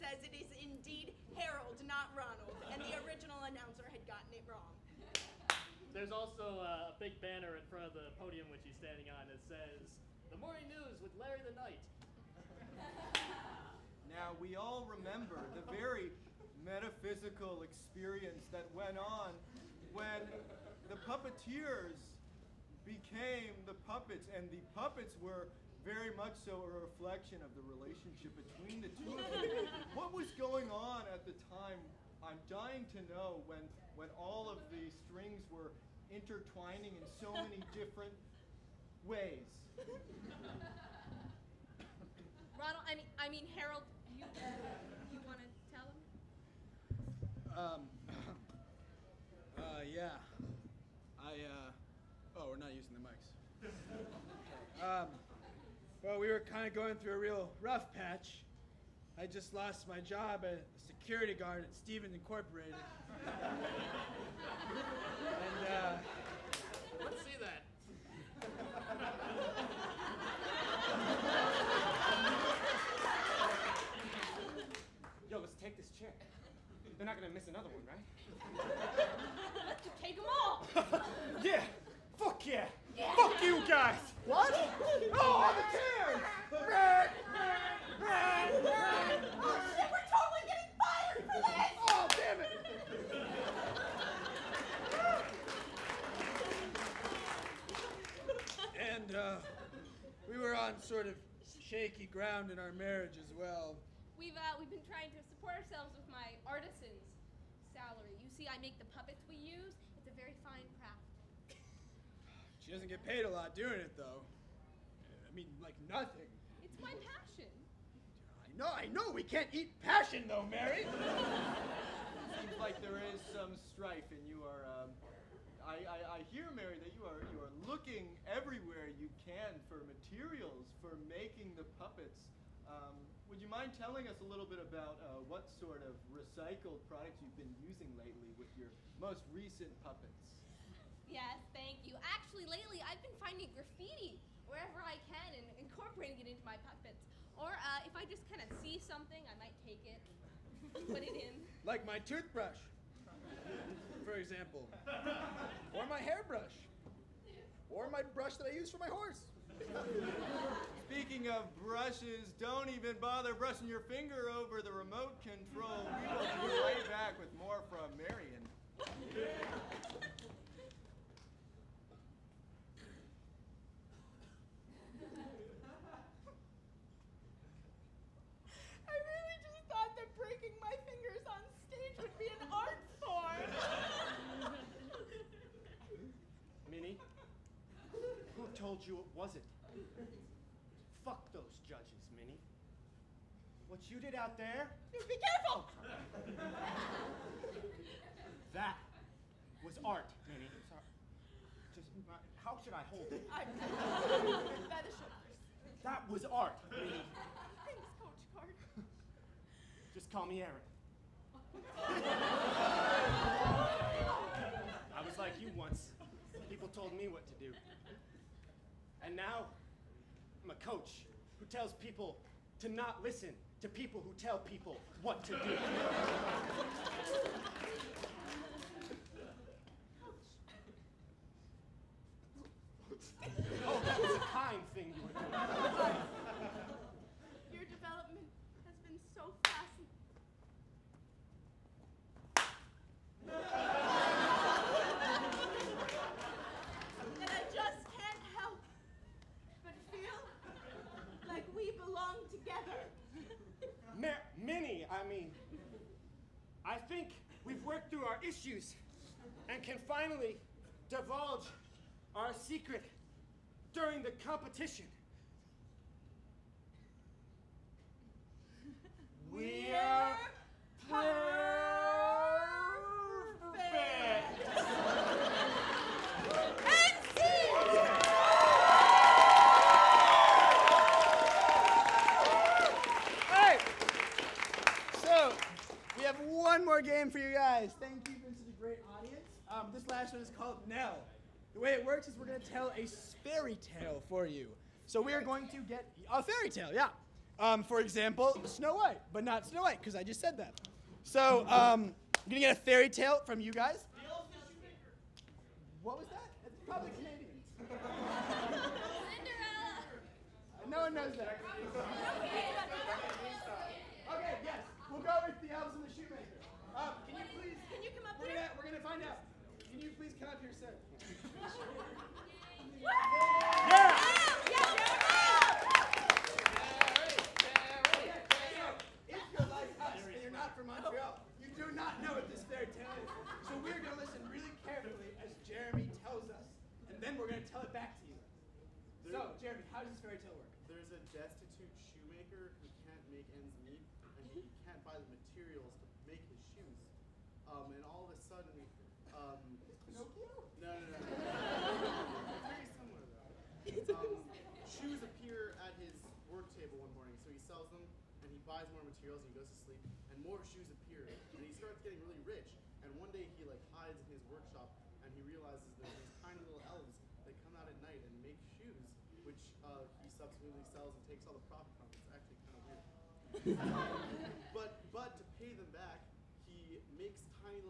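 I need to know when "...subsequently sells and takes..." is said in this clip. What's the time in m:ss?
6:10.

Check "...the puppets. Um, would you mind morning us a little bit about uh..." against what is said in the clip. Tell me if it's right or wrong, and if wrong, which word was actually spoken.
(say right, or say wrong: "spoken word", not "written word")
wrong: "telling", not "morning".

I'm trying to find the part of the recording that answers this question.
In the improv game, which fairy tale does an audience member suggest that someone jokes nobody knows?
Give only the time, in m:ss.
5:09.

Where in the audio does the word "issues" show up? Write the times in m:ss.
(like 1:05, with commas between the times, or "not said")
4:18.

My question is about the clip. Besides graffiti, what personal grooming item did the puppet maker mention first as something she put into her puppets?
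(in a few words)
toothbrush.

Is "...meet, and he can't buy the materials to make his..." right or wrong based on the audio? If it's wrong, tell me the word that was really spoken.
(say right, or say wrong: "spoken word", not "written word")
right.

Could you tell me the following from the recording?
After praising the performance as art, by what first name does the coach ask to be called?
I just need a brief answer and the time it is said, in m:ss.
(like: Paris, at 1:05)
Aaron, at 3:30.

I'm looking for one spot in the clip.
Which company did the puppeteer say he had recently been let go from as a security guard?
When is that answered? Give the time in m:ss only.
1:01.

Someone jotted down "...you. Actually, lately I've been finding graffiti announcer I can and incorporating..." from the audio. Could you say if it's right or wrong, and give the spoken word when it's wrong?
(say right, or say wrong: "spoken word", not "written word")
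wrong: "wherever", not "announcer".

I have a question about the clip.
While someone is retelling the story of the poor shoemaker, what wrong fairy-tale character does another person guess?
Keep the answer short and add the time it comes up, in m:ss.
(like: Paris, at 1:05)
Pinocchio, at 5:49.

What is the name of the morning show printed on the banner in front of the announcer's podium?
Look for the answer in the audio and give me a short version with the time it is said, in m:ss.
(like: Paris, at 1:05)
The Morning News with Larry the Knight, at 0:10.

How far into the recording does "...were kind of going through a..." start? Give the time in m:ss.
0:56.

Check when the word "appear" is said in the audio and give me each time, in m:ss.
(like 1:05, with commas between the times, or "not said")
5:54, 6:00.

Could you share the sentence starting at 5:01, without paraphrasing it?
So um, I'm going to get a fairy tale from you guys.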